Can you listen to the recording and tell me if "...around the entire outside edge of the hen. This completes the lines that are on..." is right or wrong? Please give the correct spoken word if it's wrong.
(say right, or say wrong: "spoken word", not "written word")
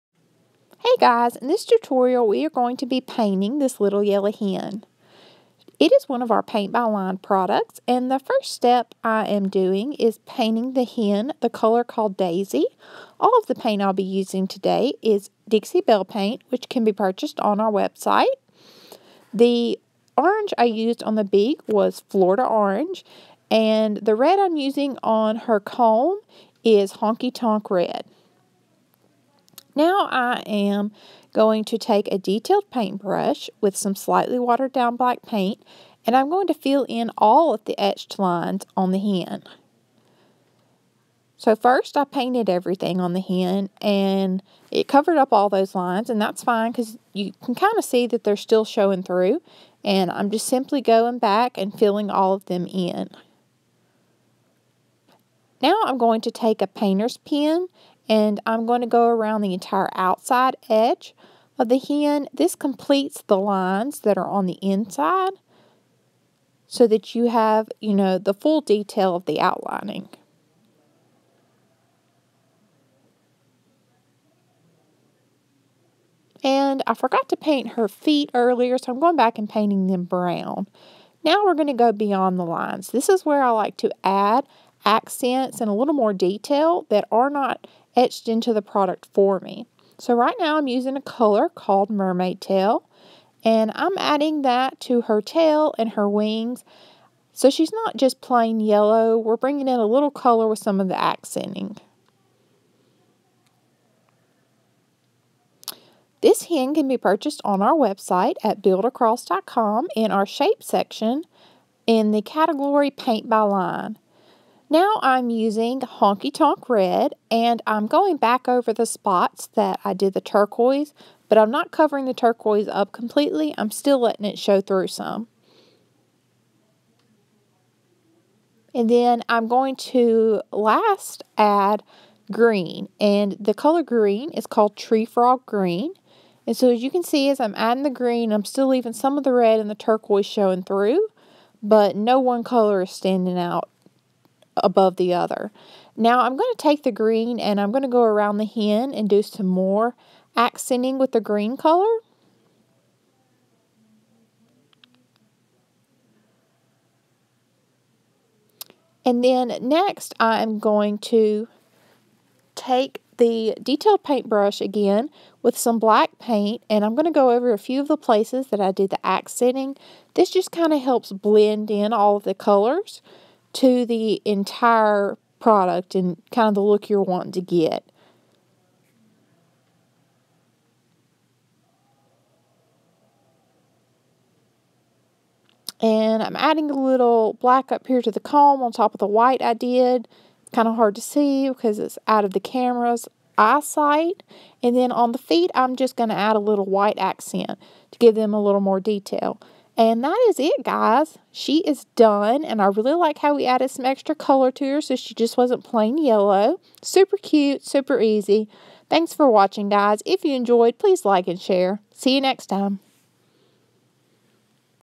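right.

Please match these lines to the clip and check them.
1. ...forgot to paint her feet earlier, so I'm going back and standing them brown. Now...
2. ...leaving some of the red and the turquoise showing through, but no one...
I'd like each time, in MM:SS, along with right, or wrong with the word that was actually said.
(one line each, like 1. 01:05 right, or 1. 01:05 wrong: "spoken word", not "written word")
1. 01:16 wrong: "painting", not "standing"
2. 02:18 right.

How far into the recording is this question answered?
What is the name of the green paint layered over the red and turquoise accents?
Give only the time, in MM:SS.
02:14.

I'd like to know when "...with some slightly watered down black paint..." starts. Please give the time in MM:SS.
00:33.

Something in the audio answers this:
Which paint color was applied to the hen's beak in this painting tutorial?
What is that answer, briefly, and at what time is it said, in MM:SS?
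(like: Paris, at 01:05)
Florida Orange, at 00:22.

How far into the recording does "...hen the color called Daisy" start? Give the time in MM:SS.
00:10.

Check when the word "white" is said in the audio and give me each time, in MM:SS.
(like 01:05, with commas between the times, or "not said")
03:09, 03:16.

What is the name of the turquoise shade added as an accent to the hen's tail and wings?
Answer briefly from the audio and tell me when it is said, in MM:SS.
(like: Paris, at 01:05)
Mermaid Tail, at 01:31.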